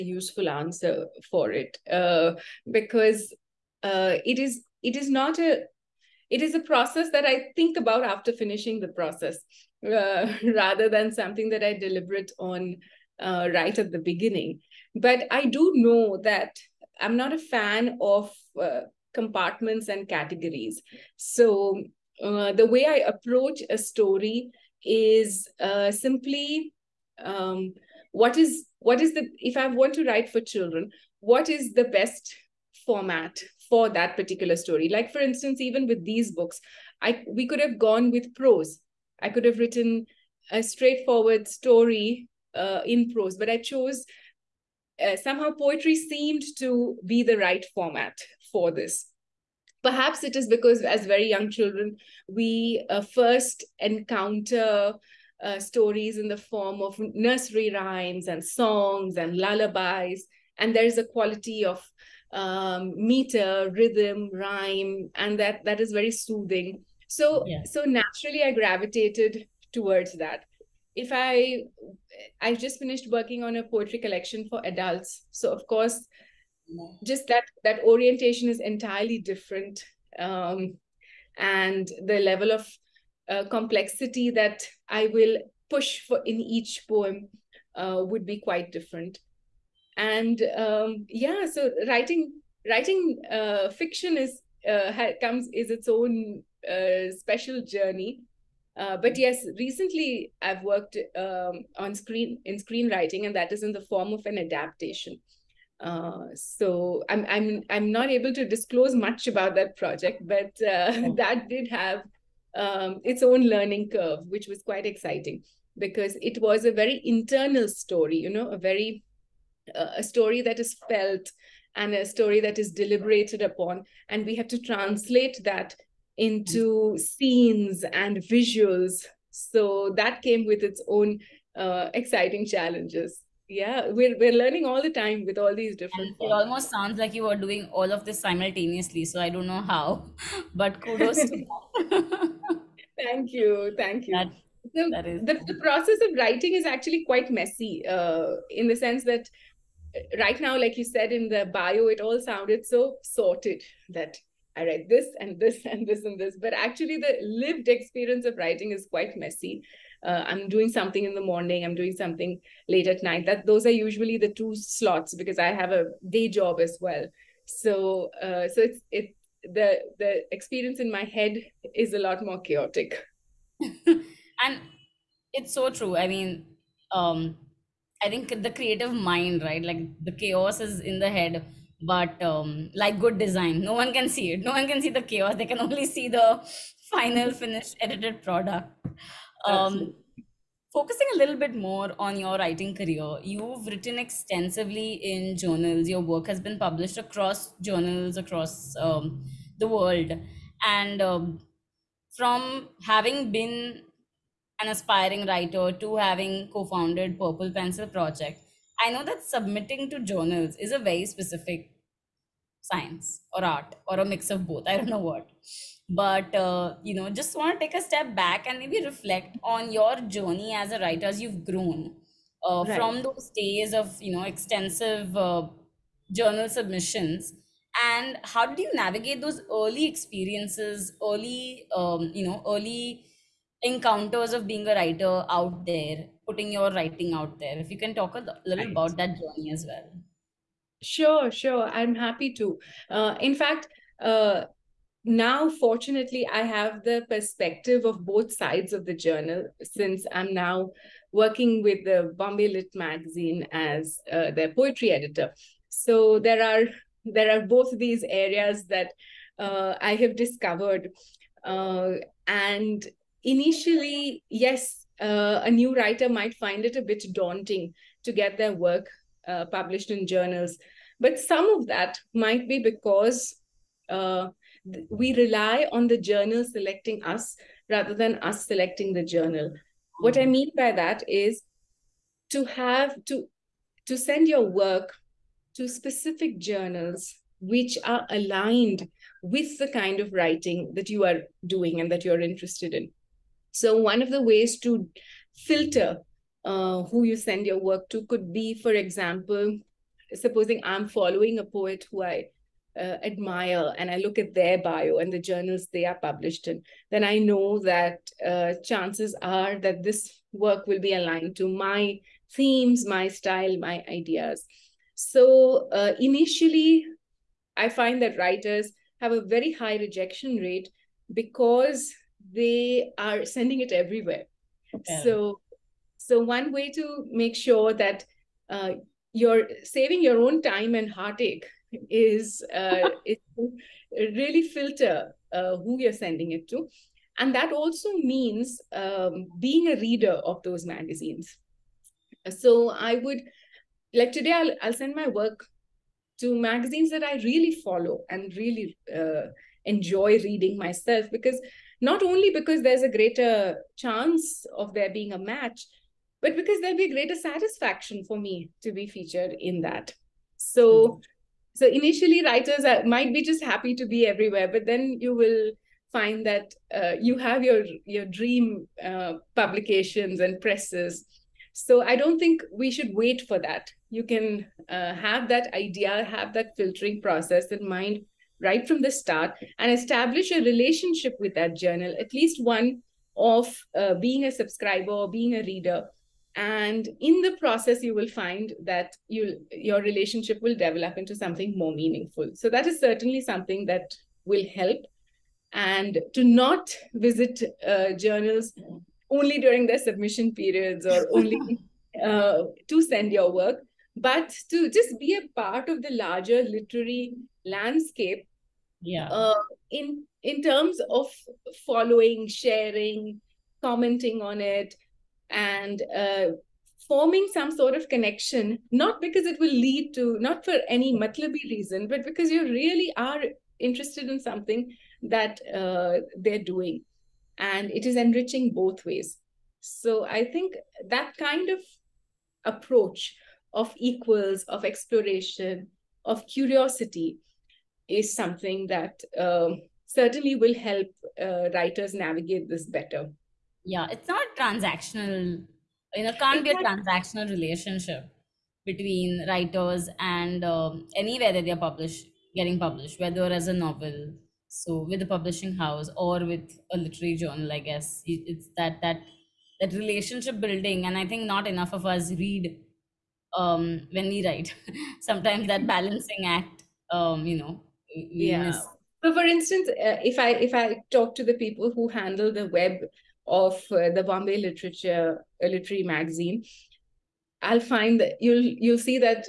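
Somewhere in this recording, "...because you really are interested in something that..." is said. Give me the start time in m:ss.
7:02.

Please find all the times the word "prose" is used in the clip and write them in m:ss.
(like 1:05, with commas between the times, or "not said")
0:38, 0:43.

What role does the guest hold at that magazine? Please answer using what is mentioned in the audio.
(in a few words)
Poetry editor.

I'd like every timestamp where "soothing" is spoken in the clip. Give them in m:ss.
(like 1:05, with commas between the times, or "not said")
1:06.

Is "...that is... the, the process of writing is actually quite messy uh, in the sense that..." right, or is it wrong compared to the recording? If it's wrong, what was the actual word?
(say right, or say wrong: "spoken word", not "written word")
right.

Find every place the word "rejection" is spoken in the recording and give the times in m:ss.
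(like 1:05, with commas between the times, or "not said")
5:19.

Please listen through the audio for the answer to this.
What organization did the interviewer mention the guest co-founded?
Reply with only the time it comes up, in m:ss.
3:27.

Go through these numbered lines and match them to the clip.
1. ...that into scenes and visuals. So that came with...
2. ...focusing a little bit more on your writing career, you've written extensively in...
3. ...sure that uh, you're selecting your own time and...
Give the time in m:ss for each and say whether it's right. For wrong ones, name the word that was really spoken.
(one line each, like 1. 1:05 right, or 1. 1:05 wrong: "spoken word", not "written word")
1. 2:05 right
2. 3:10 right
3. 5:27 wrong: "saving", not "selecting".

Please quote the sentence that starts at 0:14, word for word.
But I do know that I'm not a fan of uh, compartments and categories.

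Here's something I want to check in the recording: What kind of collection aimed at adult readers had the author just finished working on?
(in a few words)
A poetry collection.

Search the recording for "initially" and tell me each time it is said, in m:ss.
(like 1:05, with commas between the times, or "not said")
4:23, 5:15, 6:01.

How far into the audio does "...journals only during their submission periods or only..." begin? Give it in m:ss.
6:37.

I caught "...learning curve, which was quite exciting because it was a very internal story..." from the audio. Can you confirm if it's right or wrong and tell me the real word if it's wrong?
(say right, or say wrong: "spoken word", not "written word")
right.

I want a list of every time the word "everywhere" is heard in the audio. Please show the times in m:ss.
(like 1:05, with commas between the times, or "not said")
5:23, 6:04.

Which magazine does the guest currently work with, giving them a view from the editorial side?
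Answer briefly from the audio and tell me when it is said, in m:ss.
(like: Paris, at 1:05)
Bombay Lit Magazine, at 4:12.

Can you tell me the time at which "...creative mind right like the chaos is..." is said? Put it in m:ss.
2:58.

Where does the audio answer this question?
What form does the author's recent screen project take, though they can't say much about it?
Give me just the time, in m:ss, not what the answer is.
1:44.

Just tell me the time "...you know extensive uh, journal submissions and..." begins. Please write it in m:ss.
3:44.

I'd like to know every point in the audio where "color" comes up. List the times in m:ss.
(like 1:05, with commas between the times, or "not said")
not said.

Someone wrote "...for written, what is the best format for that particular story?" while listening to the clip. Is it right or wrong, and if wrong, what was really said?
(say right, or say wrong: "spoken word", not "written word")
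wrong: "children", not "written".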